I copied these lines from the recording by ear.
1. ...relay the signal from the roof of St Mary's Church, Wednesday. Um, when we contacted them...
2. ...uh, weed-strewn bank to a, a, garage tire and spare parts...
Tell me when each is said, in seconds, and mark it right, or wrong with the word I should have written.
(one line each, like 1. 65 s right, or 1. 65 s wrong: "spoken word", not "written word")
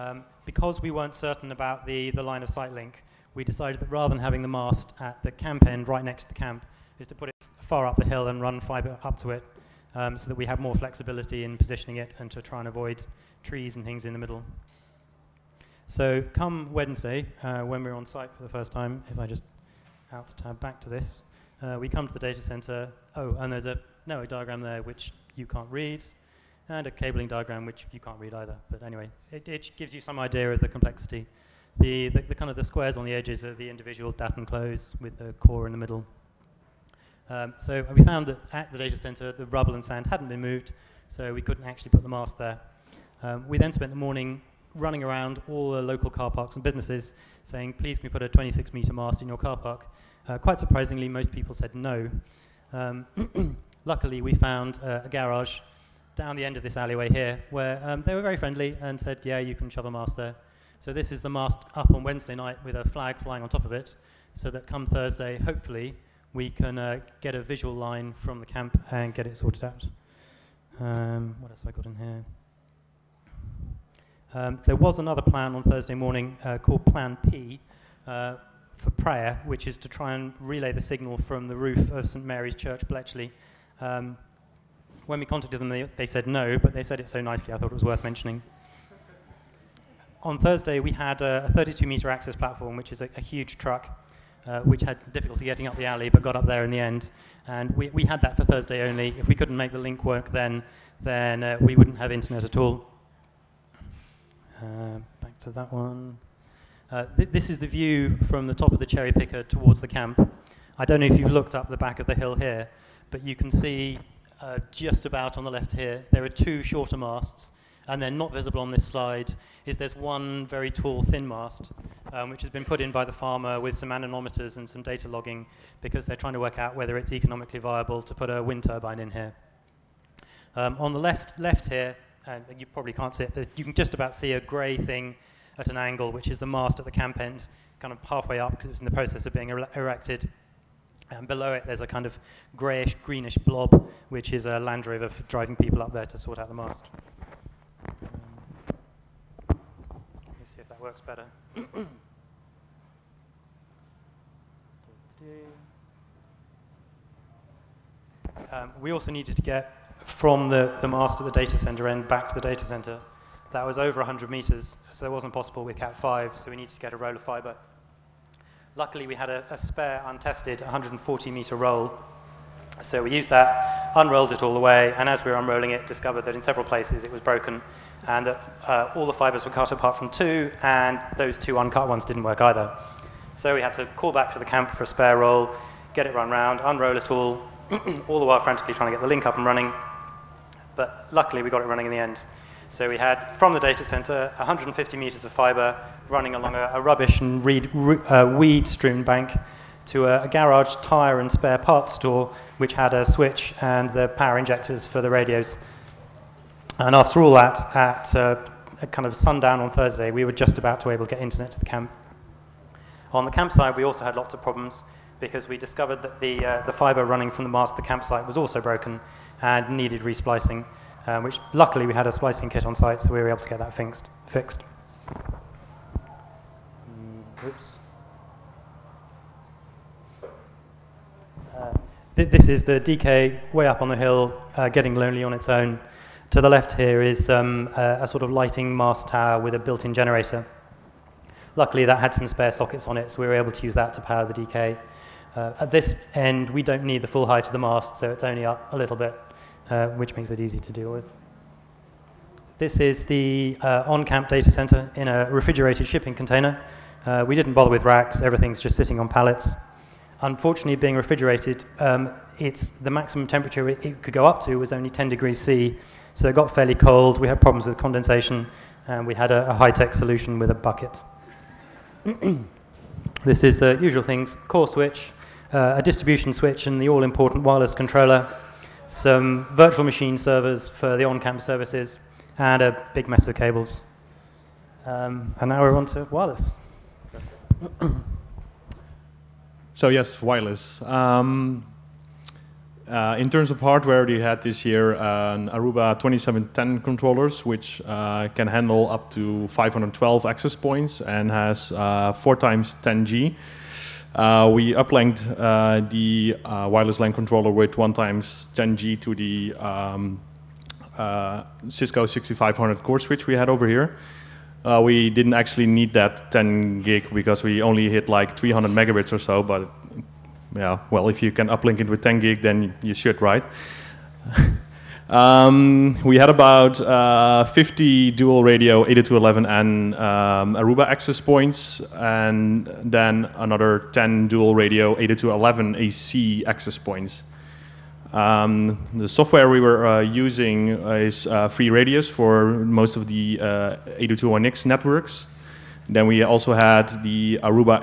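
1. 80 s wrong: "Bletchley", not "Wednesday"
2. 197 s right.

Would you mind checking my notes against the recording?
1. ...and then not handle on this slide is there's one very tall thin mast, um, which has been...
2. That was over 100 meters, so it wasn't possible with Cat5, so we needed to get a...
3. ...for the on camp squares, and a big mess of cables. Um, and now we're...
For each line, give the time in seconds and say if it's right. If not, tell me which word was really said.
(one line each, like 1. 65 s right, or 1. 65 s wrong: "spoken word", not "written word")
1. 117 s wrong: "visible", not "handle"
2. 163 s right
3. 280 s wrong: "services", not "squares".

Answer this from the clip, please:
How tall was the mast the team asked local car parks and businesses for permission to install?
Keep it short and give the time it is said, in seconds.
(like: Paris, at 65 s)
26 meters, at 48 s.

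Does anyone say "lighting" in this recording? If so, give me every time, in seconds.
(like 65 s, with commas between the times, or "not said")
238 s.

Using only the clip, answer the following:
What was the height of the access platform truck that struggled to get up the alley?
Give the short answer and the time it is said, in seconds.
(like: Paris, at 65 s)
32 meters, at 91 s.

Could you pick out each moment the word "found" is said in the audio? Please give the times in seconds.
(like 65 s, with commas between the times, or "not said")
38 s, 54 s.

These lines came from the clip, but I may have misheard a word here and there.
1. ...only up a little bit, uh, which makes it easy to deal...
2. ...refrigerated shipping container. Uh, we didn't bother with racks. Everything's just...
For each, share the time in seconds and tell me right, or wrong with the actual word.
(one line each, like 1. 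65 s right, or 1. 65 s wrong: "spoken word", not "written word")
1. 248 s right
2. 255 s right.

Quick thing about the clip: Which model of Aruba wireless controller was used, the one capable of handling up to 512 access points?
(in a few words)
2710.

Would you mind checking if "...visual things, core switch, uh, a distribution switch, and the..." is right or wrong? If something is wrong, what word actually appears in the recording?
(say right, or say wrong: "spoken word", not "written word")
wrong: "usual", not "visual".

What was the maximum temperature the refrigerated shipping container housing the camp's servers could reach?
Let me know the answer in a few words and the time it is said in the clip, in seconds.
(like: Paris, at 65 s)
10°C, at 264 s.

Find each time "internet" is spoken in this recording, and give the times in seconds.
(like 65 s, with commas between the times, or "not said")
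102 s, 211 s.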